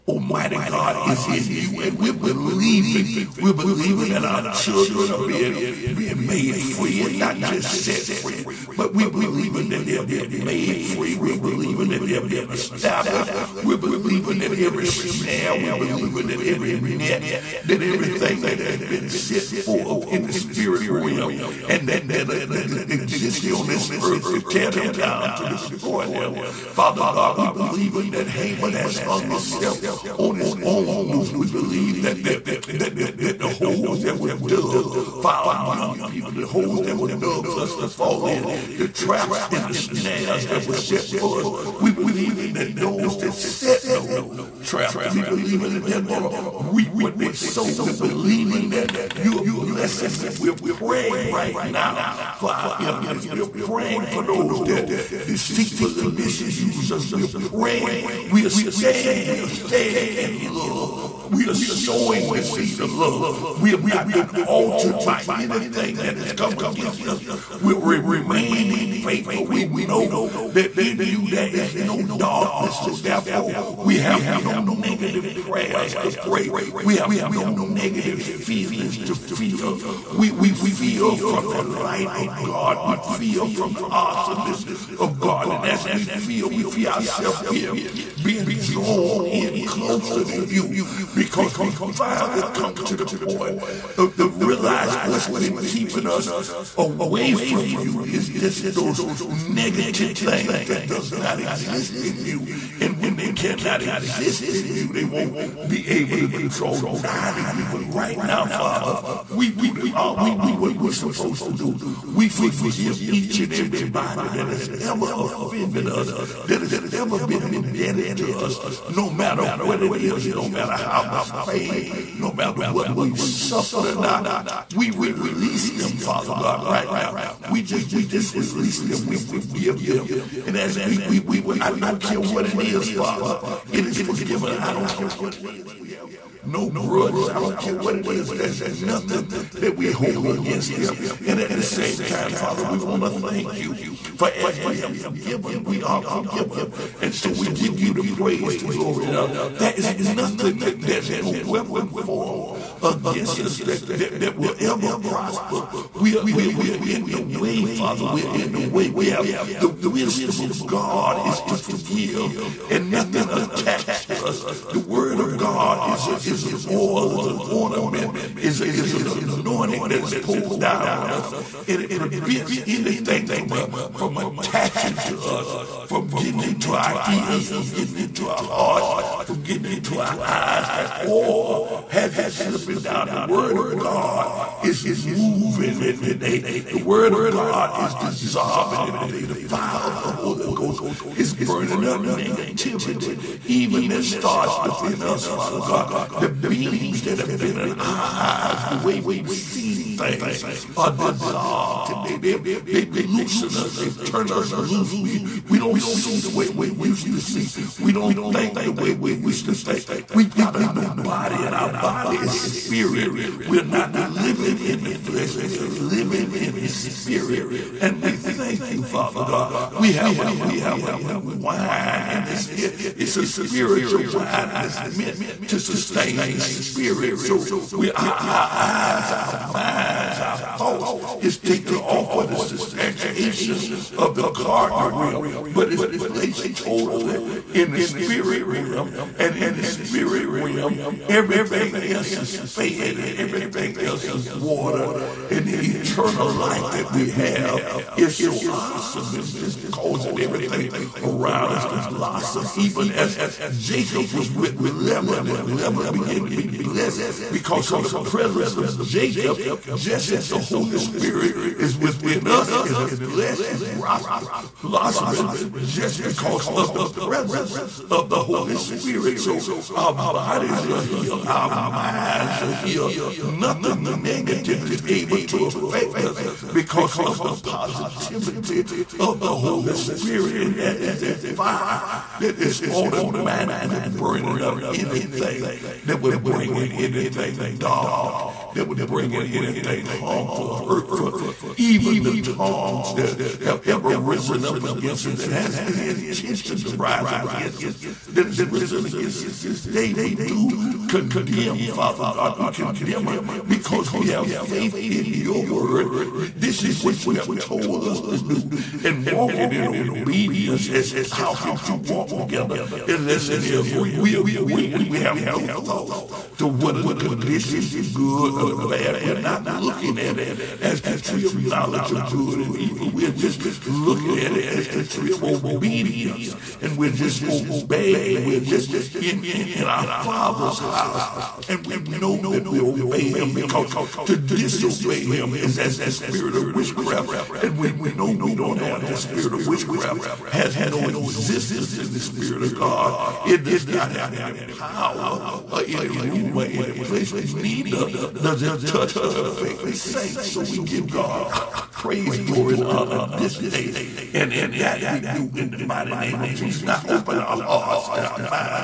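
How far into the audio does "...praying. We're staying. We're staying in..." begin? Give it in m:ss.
0:57.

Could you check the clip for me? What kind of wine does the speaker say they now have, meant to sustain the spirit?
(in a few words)
new wine.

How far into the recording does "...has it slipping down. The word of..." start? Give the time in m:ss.
3:01.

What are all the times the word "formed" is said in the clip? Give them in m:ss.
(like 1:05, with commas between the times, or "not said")
2:31.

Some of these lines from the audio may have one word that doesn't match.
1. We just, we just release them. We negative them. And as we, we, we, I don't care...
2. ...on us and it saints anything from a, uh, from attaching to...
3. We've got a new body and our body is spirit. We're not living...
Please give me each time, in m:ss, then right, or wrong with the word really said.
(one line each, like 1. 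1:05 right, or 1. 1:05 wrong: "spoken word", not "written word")
1. 2:07 wrong: "forgive", not "negative"
2. 2:50 wrong: "prevents", not "saints"
3. 3:30 right.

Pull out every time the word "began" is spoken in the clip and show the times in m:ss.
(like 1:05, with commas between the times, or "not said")
4:15.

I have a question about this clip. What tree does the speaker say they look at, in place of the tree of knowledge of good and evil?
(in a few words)
tree of obedience.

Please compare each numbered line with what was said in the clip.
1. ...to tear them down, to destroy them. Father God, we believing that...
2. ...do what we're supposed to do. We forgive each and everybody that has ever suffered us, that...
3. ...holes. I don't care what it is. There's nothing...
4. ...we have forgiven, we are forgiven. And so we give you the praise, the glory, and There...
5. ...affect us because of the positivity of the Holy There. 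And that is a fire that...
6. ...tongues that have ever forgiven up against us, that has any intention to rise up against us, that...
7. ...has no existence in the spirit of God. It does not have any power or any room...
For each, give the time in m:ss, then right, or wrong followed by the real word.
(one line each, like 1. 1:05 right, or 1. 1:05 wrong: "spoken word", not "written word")
1. 0:24 right
2. 1:50 wrong: "offended", not "suffered"
3. 2:16 wrong: "grudges", not "holes"
4. 2:24 right
5. 4:35 wrong: "Spirit", not "There"
6. 4:52 wrong: "risen", not "forgiven"
7. 5:40 right.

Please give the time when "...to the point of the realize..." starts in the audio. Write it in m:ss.
1:32.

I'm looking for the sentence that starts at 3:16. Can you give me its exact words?
The beams that have been in our eyes, the way we've seen things are dissolved robbed they, they've, they've loosened us.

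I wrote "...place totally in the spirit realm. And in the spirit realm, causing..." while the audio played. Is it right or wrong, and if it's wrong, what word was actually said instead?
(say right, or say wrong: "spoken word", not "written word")
wrong: "everything", not "causing".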